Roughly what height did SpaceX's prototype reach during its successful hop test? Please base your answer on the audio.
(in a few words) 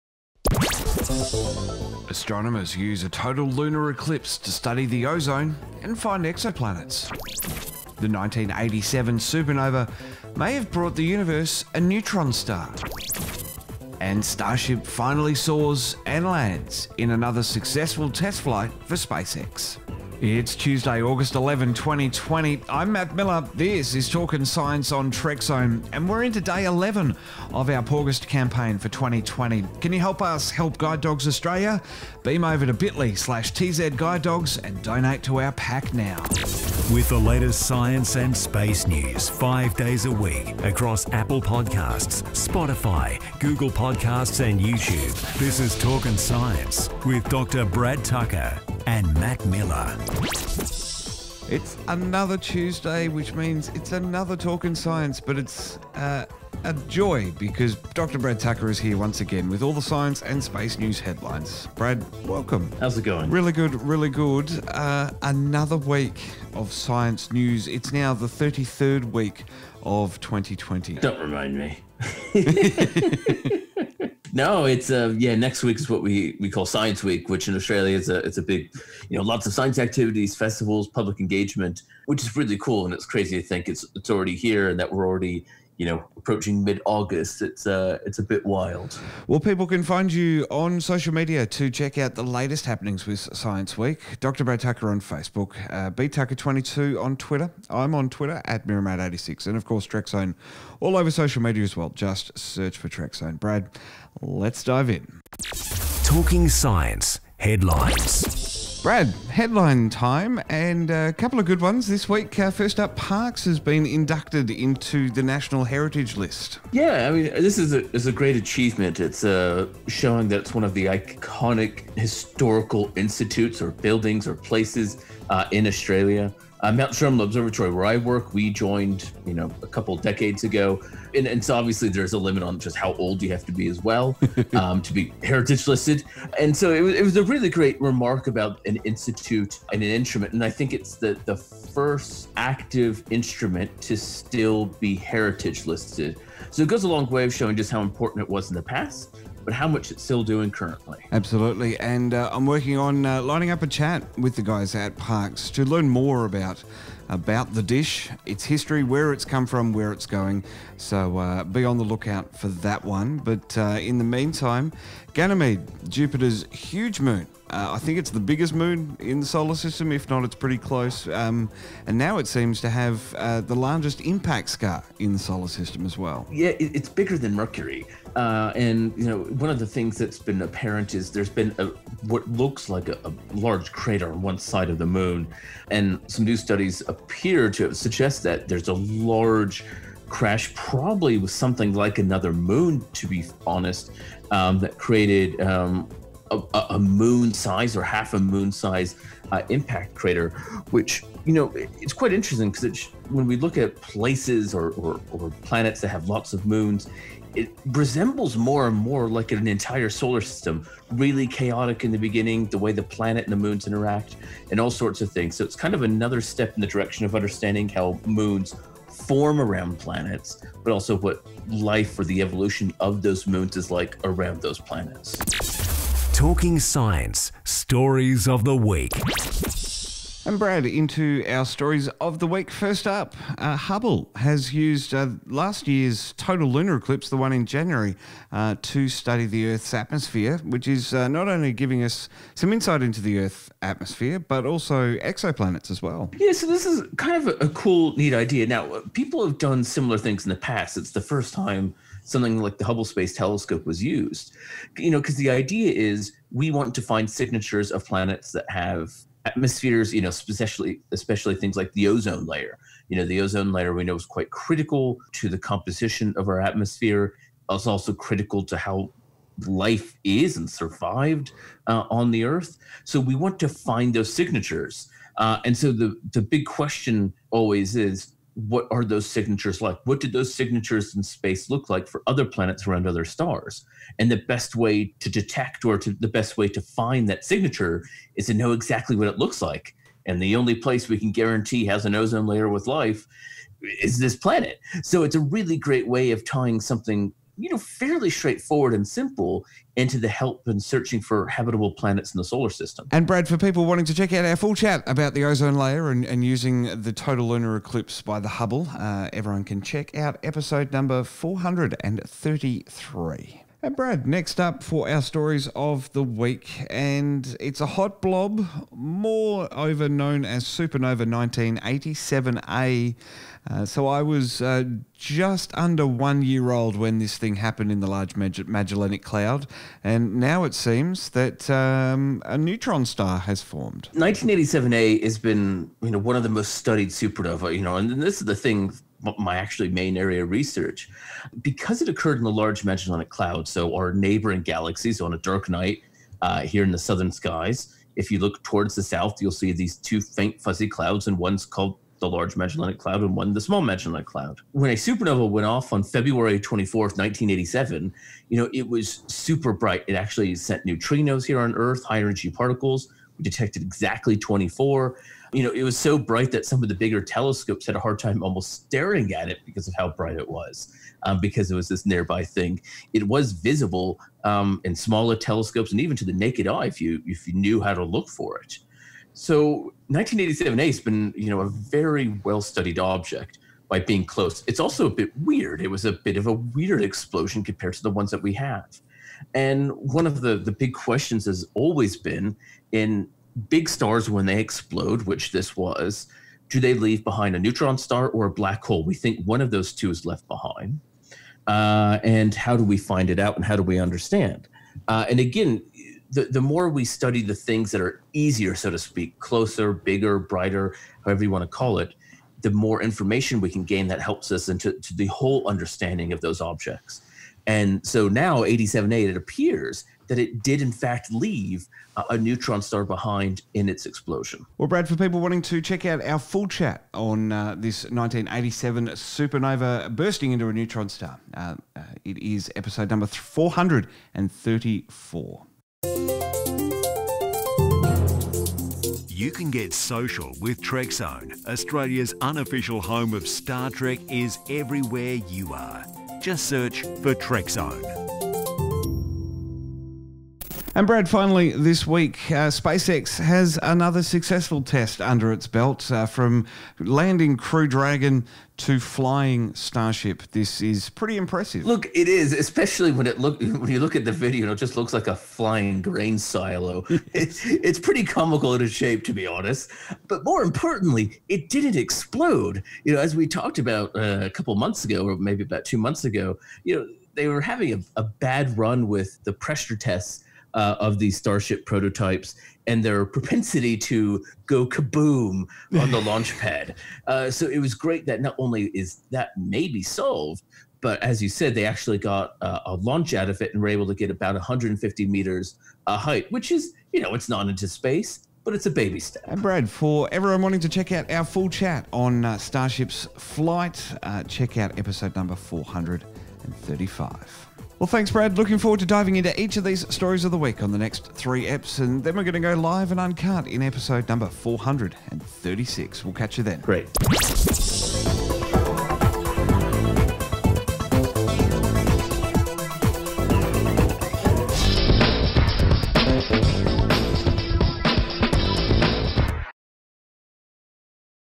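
150 meters.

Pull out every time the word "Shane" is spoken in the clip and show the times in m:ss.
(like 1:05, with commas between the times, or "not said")
not said.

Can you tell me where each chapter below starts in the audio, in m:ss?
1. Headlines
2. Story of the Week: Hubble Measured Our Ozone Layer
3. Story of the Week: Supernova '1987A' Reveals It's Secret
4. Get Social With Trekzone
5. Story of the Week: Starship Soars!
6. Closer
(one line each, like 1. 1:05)
1. 1:45
2. 3:47
3. 5:14
4. 7:15
5. 7:30
6. 8:27.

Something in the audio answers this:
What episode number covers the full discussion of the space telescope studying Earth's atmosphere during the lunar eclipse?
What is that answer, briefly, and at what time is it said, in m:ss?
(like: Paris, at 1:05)
433, at 5:11.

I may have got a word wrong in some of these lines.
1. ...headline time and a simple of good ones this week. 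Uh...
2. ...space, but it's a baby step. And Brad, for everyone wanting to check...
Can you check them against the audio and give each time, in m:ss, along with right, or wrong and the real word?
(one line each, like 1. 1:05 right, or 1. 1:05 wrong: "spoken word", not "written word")
1. 1:49 wrong: "couple", not "simple"
2. 8:17 right.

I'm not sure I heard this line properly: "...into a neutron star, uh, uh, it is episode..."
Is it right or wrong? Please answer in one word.
right.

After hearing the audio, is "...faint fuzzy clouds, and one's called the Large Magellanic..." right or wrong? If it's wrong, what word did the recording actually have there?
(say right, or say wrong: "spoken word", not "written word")
right.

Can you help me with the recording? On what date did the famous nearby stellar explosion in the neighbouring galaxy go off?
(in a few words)
February 24th, 1987.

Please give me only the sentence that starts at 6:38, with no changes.
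We think one of those two is left behind.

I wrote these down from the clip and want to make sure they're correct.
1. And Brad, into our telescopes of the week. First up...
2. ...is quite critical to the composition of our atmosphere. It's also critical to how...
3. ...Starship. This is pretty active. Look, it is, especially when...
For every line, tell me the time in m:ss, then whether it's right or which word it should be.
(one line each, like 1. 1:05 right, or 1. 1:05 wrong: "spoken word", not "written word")
1. 3:50 wrong: "stories", not "telescopes"
2. 4:23 right
3. 7:39 wrong: "impressive", not "active".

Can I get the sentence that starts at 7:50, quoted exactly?
But more importantly, it didn't explode.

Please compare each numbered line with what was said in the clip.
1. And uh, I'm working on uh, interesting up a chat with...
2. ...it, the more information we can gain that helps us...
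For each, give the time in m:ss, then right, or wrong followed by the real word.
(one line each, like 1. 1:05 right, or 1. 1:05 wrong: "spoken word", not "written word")
1. 2:31 wrong: "lining", not "interesting"
2. 6:51 right.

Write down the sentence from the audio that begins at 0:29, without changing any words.
Can you help us help Guide Dogs Australia?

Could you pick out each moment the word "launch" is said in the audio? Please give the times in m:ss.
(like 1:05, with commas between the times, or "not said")
8:06, 8:12.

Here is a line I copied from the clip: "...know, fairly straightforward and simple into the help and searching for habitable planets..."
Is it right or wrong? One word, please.
right.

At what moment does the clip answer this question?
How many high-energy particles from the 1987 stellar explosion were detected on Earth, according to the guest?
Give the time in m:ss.
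6:04.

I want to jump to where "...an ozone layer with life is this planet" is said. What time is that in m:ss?
4:51.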